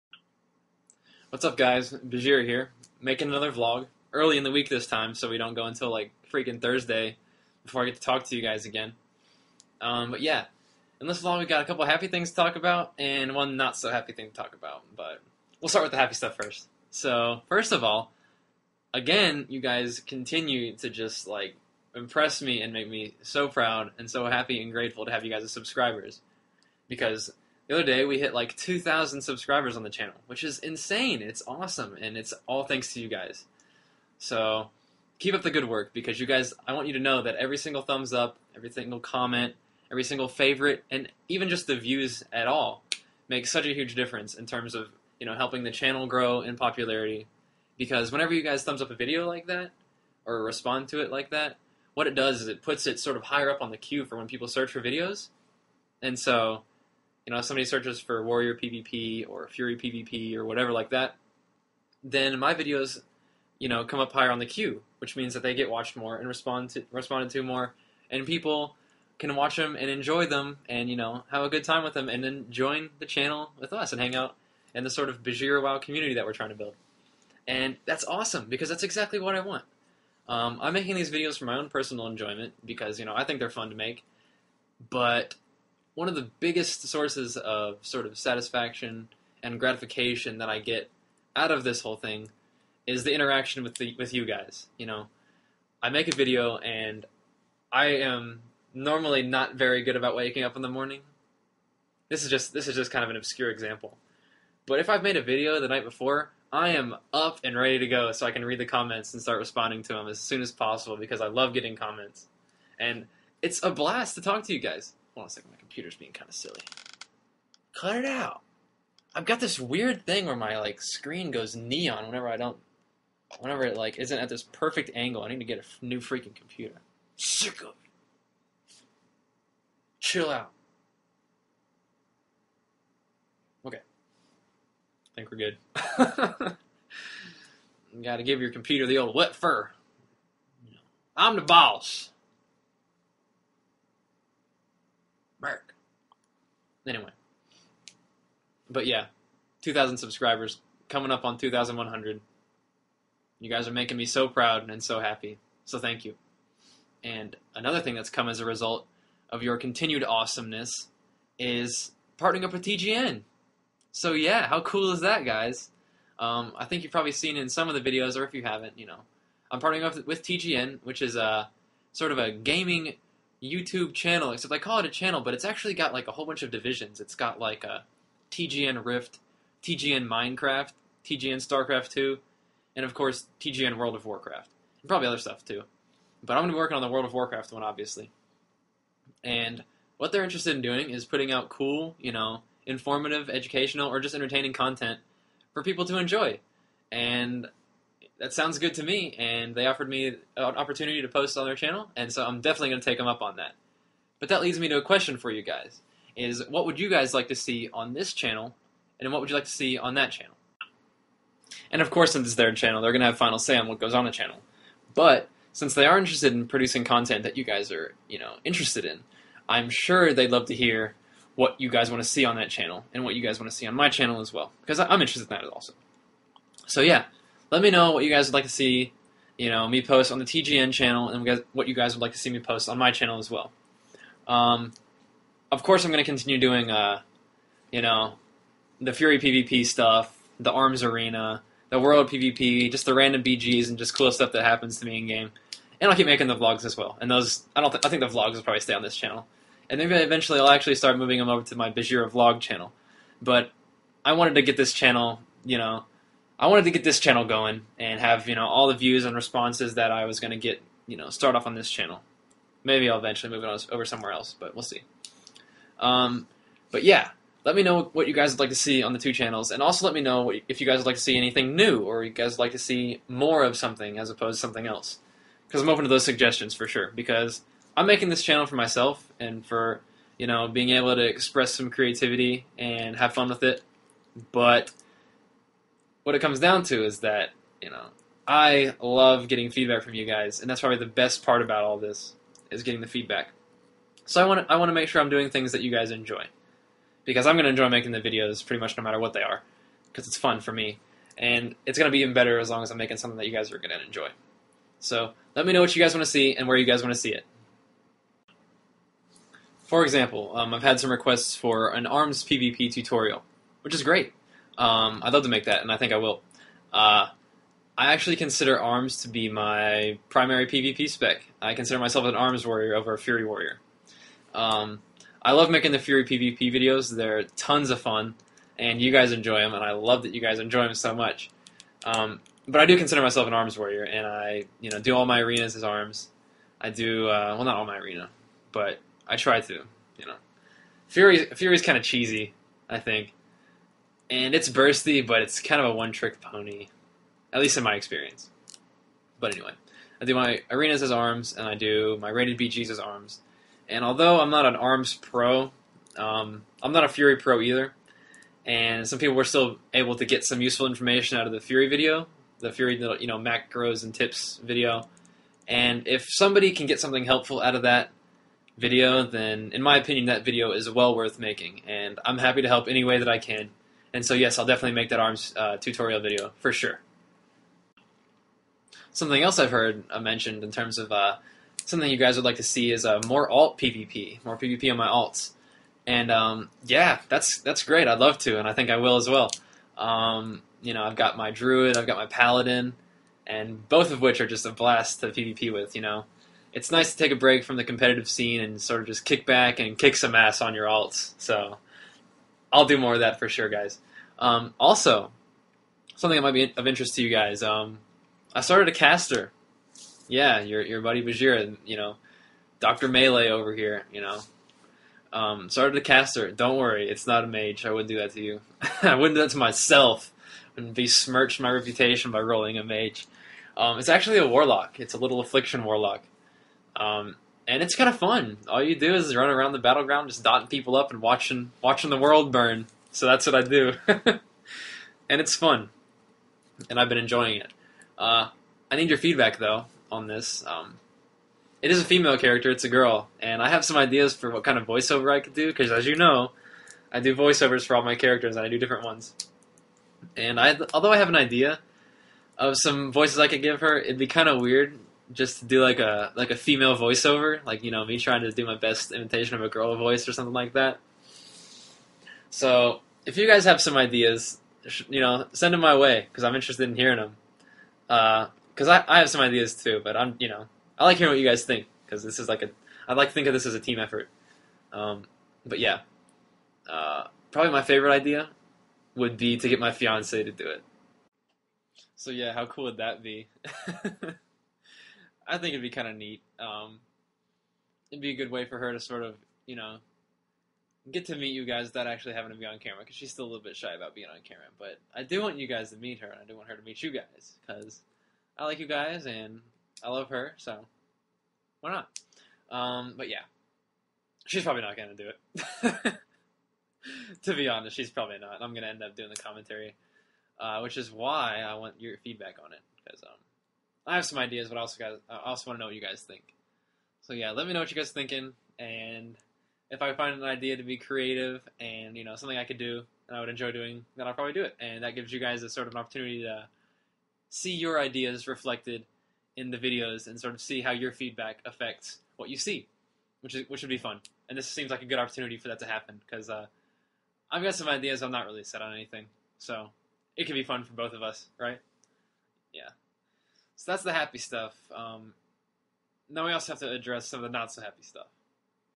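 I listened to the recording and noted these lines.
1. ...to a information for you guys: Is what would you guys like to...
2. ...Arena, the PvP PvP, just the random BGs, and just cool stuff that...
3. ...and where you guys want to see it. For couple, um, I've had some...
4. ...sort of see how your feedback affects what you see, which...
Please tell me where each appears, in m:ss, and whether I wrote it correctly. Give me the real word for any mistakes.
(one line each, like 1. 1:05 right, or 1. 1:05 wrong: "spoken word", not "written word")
1. 3:24 wrong: "question", not "information"
2. 4:00 wrong: "World", not "PvP"
3. 5:06 wrong: "example", not "couple"
4. 8:50 right.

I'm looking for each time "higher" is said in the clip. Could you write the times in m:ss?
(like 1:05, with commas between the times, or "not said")
0:53, 1:04.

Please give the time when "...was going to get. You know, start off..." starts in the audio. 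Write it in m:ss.
4:20.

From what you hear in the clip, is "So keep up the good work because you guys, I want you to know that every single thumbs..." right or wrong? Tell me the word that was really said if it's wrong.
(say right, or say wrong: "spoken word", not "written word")
right.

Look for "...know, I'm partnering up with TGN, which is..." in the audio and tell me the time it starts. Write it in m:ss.
2:48.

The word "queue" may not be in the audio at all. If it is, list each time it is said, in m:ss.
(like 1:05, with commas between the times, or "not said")
0:53, 1:04.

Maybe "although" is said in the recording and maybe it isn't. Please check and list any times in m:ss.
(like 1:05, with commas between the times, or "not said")
5:53, 7:30.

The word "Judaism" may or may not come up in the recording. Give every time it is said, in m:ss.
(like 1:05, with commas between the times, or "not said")
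not said.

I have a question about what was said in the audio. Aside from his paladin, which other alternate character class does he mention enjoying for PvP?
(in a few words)
Druid.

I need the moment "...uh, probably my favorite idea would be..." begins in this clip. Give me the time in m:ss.
7:56.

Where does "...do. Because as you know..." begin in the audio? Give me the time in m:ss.
7:25.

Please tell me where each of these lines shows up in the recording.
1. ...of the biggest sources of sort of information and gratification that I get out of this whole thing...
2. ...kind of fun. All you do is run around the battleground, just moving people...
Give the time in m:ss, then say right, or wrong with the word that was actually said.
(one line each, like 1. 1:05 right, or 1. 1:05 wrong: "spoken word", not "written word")
1. 1:26 wrong: "satisfaction", not "information"
2. 7:07 wrong: "dotting", not "moving".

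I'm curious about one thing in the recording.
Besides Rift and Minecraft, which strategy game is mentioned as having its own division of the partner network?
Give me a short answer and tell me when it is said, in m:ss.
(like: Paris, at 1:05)
StarCraft 2, at 3:01.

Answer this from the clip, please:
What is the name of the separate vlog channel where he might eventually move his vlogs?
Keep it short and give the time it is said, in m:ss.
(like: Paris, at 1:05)
Bajheera vlog channel, at 4:11.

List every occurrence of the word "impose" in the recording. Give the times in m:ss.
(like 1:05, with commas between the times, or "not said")
not said.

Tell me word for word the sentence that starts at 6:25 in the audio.
And um, yeah, that's that's great.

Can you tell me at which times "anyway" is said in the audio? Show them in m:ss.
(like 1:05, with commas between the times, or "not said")
2:26, 5:49.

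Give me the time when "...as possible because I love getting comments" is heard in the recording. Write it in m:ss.
1:50.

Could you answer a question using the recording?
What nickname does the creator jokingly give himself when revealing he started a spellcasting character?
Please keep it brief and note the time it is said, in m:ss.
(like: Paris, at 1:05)
Doctor Melee, at 6:52.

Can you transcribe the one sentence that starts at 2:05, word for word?
I need to get a f- new freaking computer.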